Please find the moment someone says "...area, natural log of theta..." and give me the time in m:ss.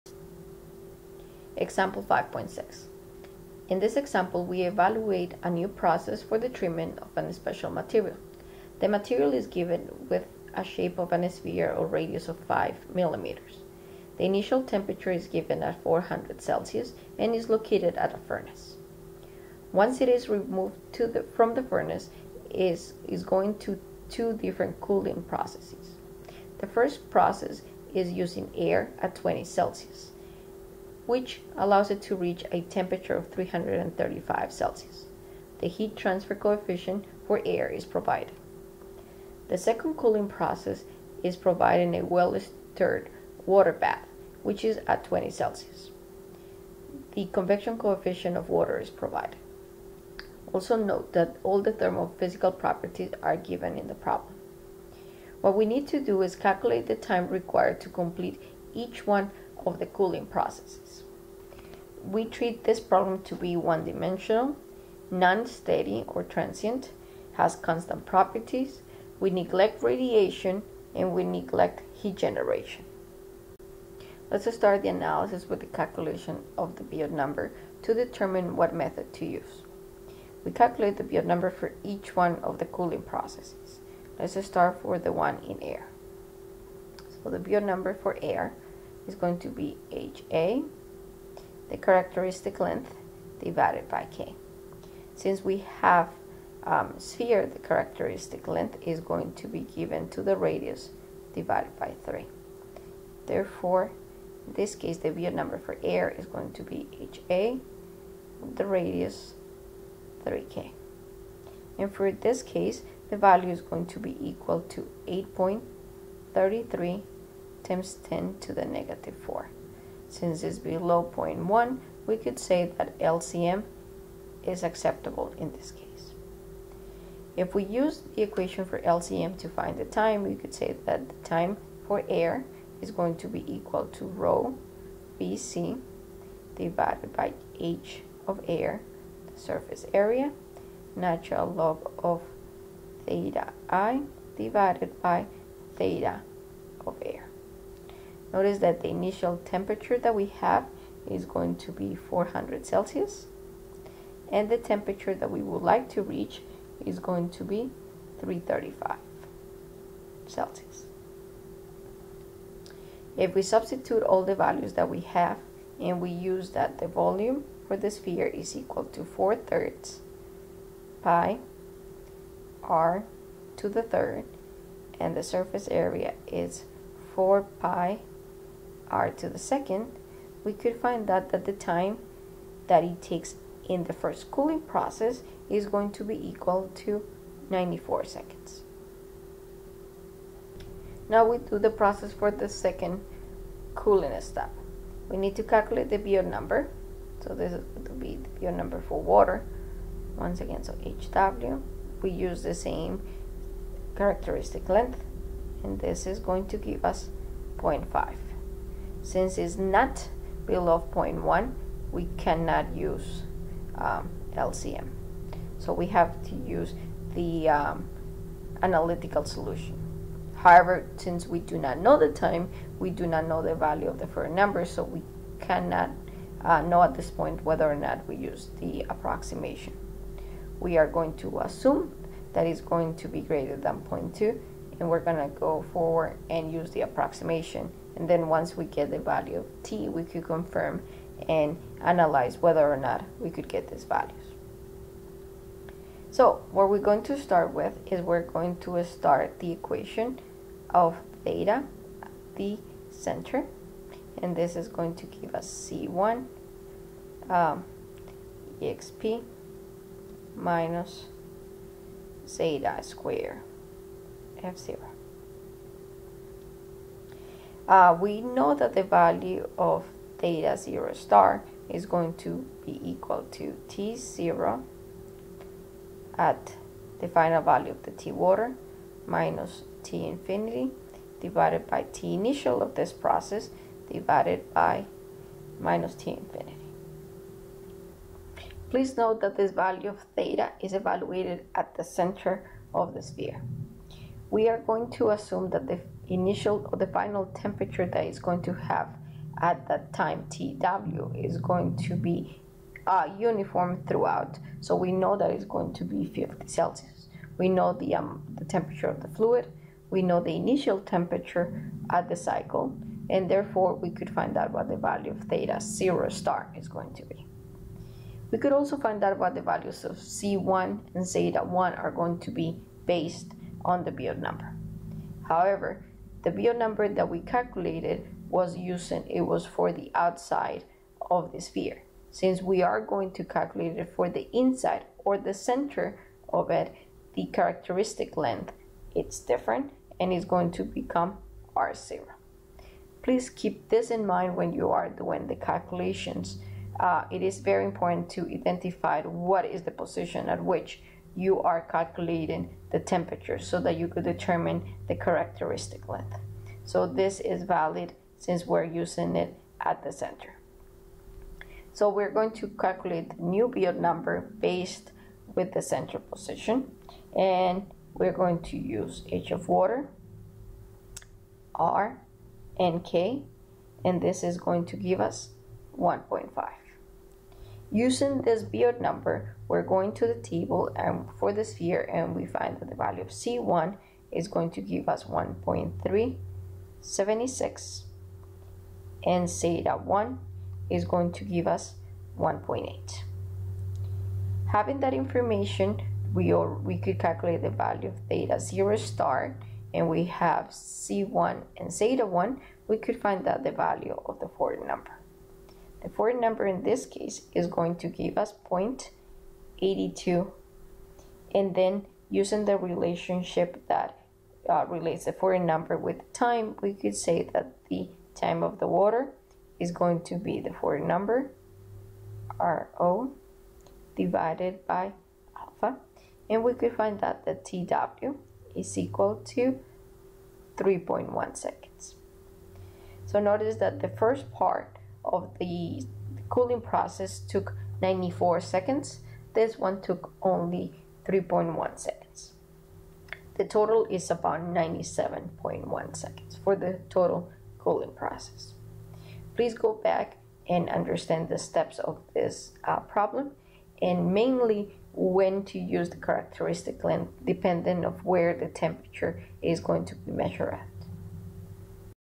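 2:19.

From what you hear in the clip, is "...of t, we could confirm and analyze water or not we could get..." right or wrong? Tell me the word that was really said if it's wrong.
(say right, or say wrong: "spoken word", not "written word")
wrong: "whether", not "water".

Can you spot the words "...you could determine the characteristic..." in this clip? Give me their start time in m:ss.
5:53.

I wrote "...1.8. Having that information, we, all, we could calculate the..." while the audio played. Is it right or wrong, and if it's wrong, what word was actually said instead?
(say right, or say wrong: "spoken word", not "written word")
right.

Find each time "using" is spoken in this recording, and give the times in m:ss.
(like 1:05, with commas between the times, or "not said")
0:28, 5:28, 5:58, 6:17, 6:52.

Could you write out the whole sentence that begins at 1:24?
Let's start for the one in air.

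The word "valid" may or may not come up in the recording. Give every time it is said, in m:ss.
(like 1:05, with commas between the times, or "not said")
5:57.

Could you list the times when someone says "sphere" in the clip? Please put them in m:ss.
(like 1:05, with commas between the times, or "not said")
0:11, 1:36, 2:47, 4:53, 5:31, 6:21.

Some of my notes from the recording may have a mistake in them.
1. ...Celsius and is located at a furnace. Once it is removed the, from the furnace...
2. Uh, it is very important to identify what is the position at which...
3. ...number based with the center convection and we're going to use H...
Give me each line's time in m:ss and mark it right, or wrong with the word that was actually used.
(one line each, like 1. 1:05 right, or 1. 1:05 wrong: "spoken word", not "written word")
1. 0:16 right
2. 5:46 right
3. 6:03 wrong: "position", not "convection".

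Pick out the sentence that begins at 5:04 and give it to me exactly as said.
So we know that it's going to be 50 Celsius.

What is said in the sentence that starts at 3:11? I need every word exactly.
Now we do the process for the second cooling step.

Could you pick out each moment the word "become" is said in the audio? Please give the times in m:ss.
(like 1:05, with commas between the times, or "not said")
5:40.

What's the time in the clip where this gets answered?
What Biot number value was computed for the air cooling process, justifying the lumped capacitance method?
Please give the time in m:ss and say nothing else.
1:55.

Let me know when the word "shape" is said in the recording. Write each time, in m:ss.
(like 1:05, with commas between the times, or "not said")
0:10.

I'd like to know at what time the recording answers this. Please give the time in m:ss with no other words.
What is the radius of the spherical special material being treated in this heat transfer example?
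0:12.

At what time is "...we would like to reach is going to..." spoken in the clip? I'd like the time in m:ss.
2:35.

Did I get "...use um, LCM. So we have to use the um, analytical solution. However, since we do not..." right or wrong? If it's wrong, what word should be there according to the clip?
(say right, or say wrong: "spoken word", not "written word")
right.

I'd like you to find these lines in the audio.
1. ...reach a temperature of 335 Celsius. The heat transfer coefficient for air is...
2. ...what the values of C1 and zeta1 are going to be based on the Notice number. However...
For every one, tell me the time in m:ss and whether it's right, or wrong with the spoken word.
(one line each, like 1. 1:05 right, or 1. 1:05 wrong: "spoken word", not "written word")
1. 0:32 right
2. 5:19 wrong: "Biot", not "Notice".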